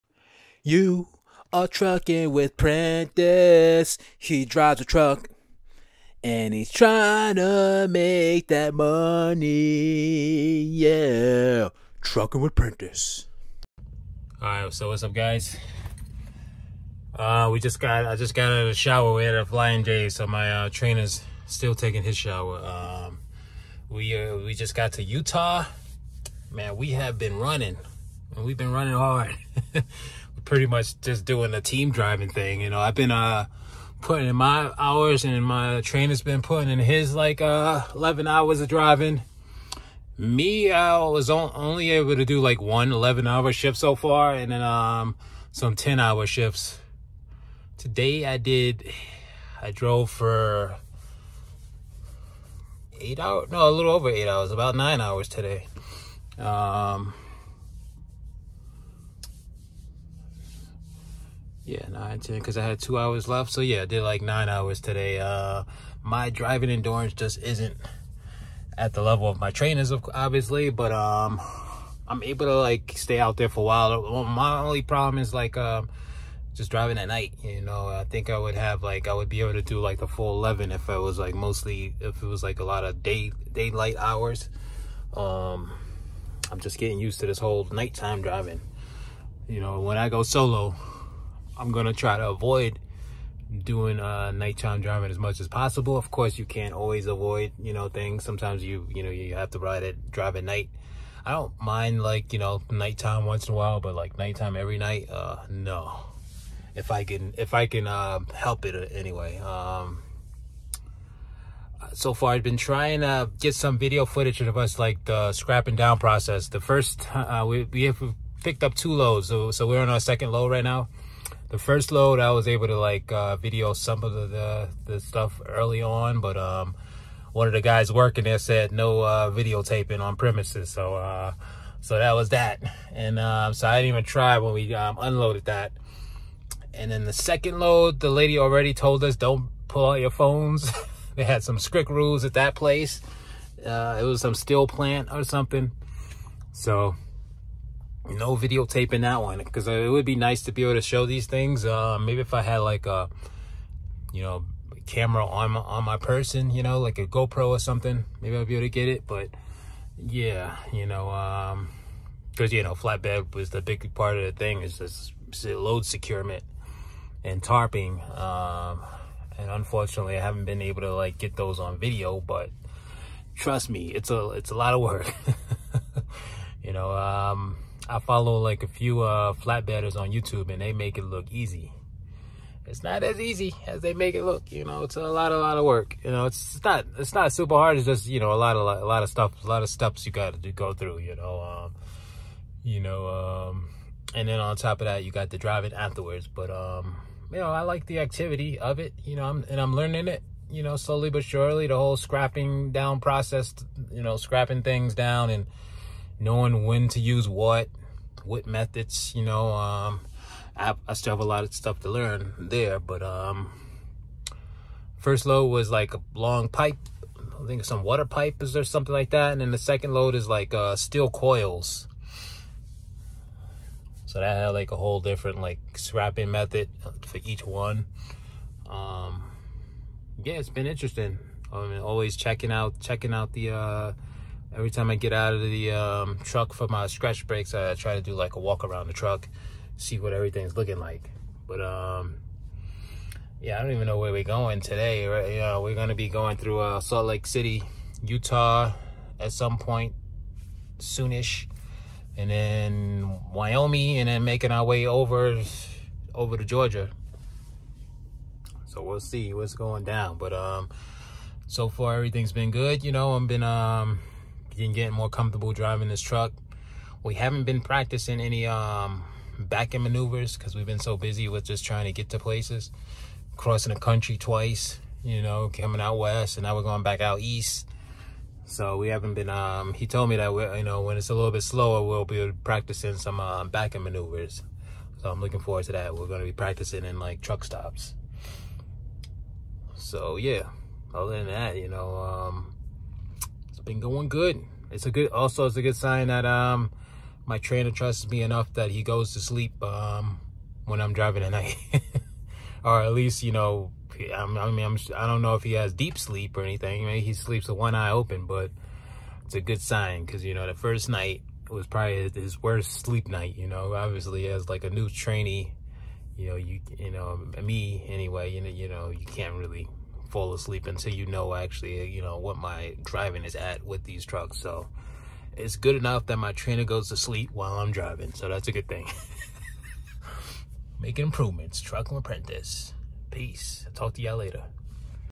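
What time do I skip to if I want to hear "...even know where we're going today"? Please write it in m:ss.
4:03.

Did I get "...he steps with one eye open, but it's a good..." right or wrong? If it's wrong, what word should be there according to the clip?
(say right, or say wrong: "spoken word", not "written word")
wrong: "sleeps", not "steps".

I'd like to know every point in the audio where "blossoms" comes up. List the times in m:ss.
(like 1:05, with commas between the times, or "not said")
not said.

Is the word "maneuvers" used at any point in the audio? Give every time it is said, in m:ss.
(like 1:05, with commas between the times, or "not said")
4:29, 4:43.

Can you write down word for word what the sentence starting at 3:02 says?
It's not as easy as they make it look, you know, it's a lot, a lot of work.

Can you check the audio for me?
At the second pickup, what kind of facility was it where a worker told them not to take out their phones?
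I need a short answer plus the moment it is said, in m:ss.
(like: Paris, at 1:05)
steel plant, at 2:24.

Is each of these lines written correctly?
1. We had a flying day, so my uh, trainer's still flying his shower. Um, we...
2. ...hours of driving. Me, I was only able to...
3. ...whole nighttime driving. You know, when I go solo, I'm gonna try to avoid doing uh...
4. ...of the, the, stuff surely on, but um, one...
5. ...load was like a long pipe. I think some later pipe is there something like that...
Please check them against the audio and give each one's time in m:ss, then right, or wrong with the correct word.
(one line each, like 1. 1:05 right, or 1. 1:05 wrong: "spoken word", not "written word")
1. 0:19 wrong: "taking", not "flying"
2. 0:38 right
3. 1:27 right
4. 2:04 wrong: "early", not "surely"
5. 3:35 wrong: "water", not "later".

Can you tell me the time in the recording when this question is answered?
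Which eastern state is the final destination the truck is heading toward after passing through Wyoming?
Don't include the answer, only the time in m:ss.
4:16.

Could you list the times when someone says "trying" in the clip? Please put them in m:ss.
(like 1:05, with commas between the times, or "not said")
0:06, 1:52, 4:31.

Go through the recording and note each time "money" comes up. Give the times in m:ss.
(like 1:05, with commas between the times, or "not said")
0:08.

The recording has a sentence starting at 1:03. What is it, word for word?
So yeah, I did like nine hours today.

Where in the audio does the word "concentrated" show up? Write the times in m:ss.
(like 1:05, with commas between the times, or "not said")
not said.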